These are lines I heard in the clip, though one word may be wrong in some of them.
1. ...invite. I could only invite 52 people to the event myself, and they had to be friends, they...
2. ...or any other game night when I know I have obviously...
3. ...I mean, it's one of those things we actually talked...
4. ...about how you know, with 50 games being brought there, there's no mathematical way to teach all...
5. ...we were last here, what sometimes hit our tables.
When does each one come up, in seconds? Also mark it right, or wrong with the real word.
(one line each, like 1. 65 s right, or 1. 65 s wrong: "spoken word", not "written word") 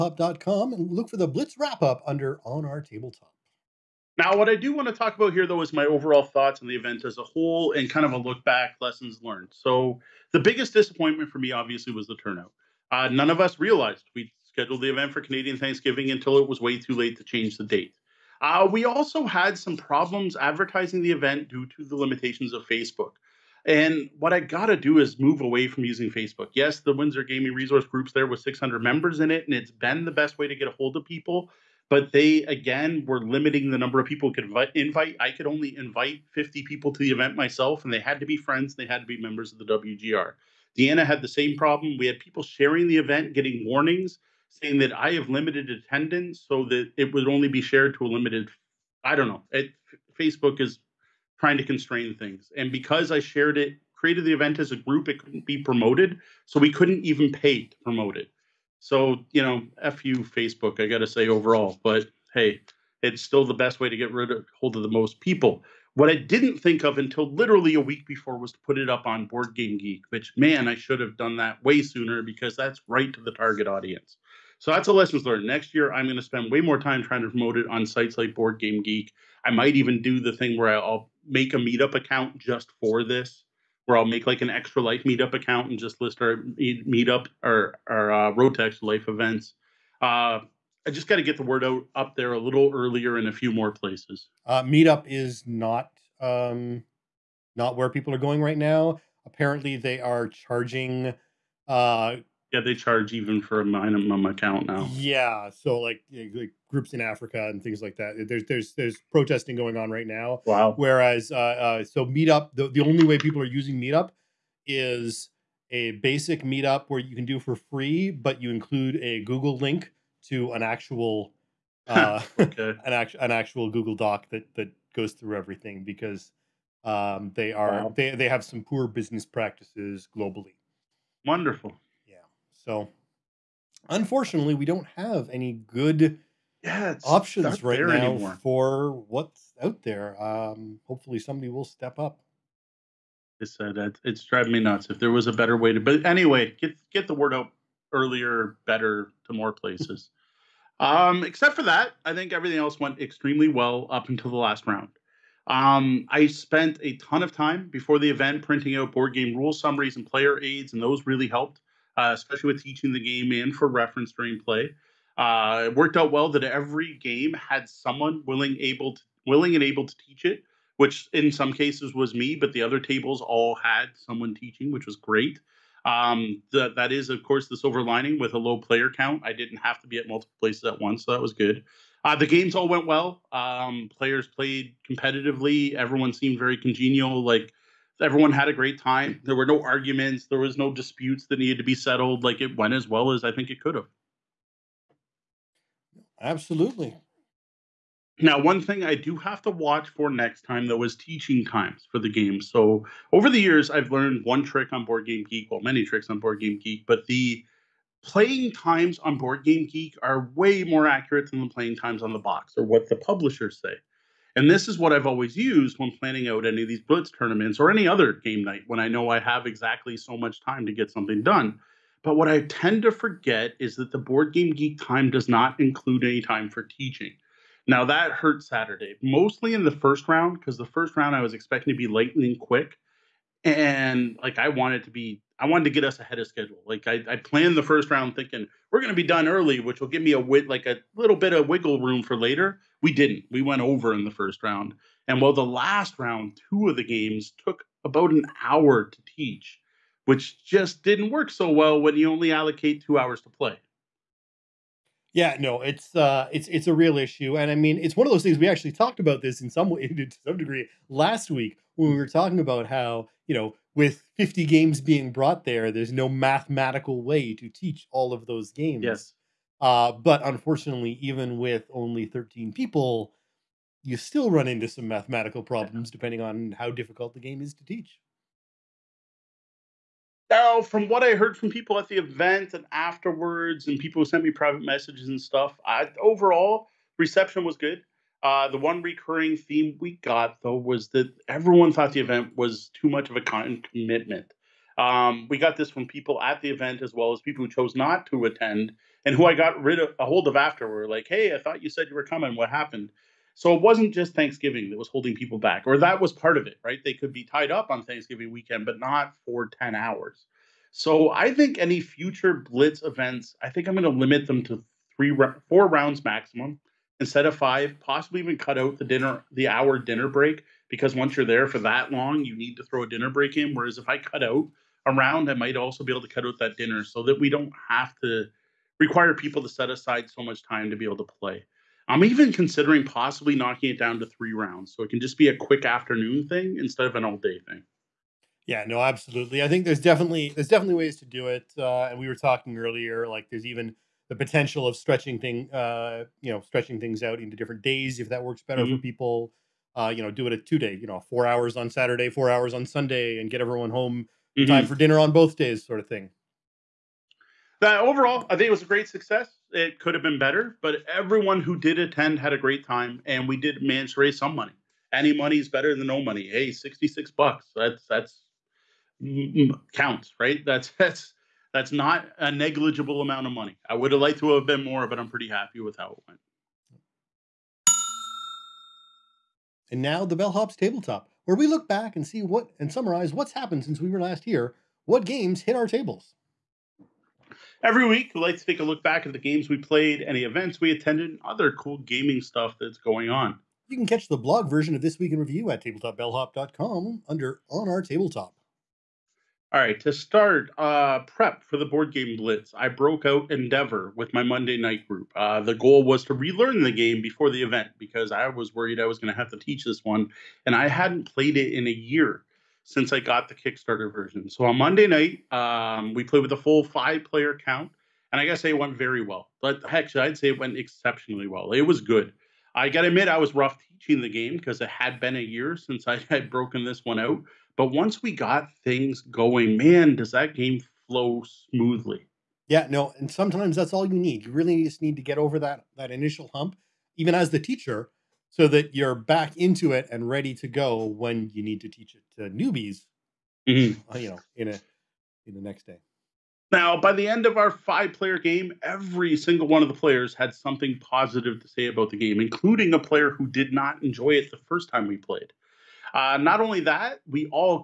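1. 34 s wrong: "50", not "52"
2. 217 s wrong: "exactly", not "obviously"
3. 257 s right
4. 262 s right
5. 383 s wrong: "games", not "sometimes".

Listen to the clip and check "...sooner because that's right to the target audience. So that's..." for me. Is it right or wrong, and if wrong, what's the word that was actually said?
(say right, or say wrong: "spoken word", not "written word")
right.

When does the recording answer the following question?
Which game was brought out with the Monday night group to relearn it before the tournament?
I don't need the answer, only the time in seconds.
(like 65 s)
403 s.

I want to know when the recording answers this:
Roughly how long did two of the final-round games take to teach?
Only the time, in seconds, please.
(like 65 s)
247 s.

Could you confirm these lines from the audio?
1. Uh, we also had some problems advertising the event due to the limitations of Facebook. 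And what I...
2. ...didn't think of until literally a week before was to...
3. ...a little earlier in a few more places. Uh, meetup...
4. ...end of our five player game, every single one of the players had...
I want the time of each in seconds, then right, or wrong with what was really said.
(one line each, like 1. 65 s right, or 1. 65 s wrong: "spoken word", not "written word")
1. 18 s right
2. 66 s right
3. 92 s right
4. 447 s right.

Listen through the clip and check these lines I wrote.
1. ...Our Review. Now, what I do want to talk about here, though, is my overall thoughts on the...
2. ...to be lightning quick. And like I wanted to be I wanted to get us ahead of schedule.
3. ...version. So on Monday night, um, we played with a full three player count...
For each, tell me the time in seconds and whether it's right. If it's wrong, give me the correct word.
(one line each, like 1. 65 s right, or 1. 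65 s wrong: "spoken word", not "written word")
1. 2 s wrong: "Tabletop", not "Review"
2. 231 s right
3. 413 s wrong: "five", not "three".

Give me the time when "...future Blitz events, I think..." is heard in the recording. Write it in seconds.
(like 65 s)
311 s.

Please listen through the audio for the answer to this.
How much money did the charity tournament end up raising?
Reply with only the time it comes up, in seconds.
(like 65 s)
366 s.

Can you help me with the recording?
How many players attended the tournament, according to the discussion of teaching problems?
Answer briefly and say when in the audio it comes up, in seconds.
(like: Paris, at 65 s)
13, at 272 s.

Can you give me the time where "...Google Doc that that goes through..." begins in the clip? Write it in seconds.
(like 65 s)
123 s.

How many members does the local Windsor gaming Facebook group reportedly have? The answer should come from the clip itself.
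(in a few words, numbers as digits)
600.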